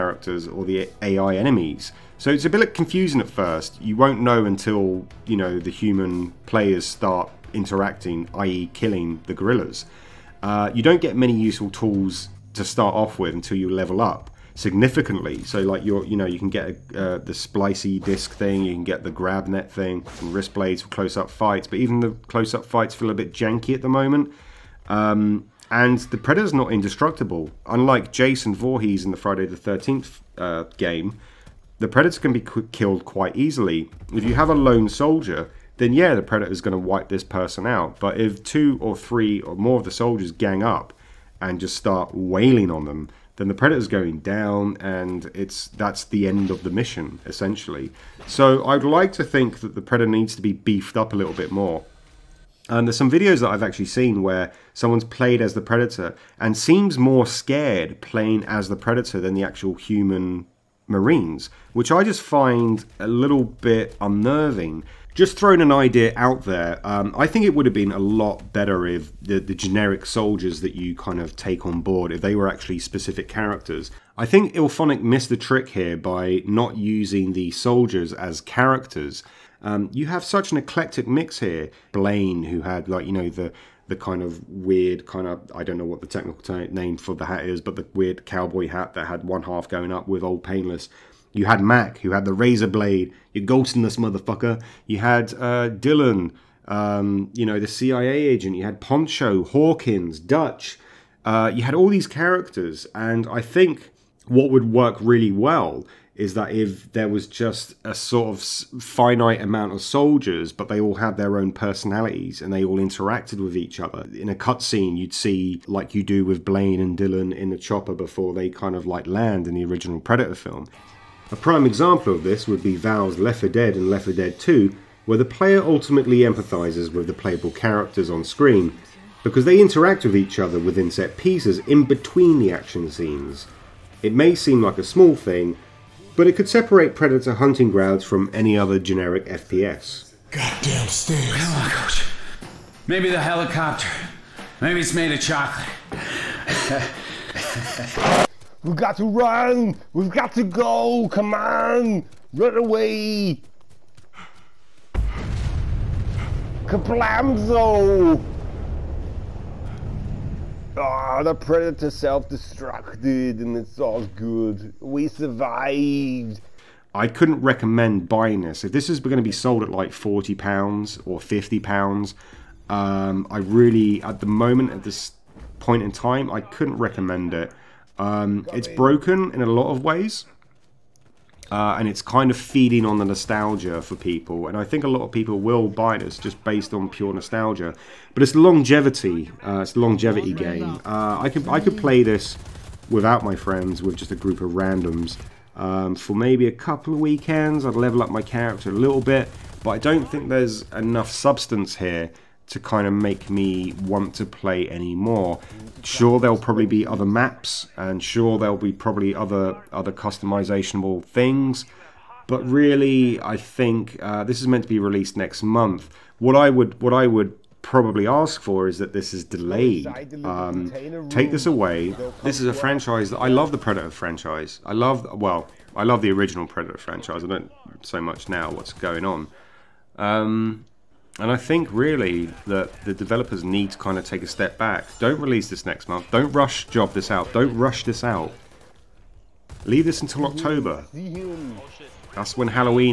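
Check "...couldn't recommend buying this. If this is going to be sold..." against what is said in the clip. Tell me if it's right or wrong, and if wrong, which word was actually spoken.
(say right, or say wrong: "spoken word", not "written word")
right.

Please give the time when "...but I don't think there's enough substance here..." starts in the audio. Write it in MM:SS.
03:19.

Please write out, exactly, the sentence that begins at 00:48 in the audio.
So I'd like to think that the predator needs to be beefed up a little bit more.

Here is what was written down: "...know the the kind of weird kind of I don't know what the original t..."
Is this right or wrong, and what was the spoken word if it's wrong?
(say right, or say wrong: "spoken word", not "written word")
wrong: "technical", not "original".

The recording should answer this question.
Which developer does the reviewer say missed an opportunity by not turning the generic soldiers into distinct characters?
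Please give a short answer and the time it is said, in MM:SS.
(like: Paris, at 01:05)
IllFonic, at 01:14.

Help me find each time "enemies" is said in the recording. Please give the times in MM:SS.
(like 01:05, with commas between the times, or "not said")
00:01.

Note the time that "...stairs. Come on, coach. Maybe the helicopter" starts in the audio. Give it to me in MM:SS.
02:20.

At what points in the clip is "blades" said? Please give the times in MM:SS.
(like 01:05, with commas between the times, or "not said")
00:20, 01:32.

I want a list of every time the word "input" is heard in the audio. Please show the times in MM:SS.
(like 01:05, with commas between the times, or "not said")
not said.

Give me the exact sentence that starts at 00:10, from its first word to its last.
Uh, you don't get many useful tools to start off with until you level up significantly.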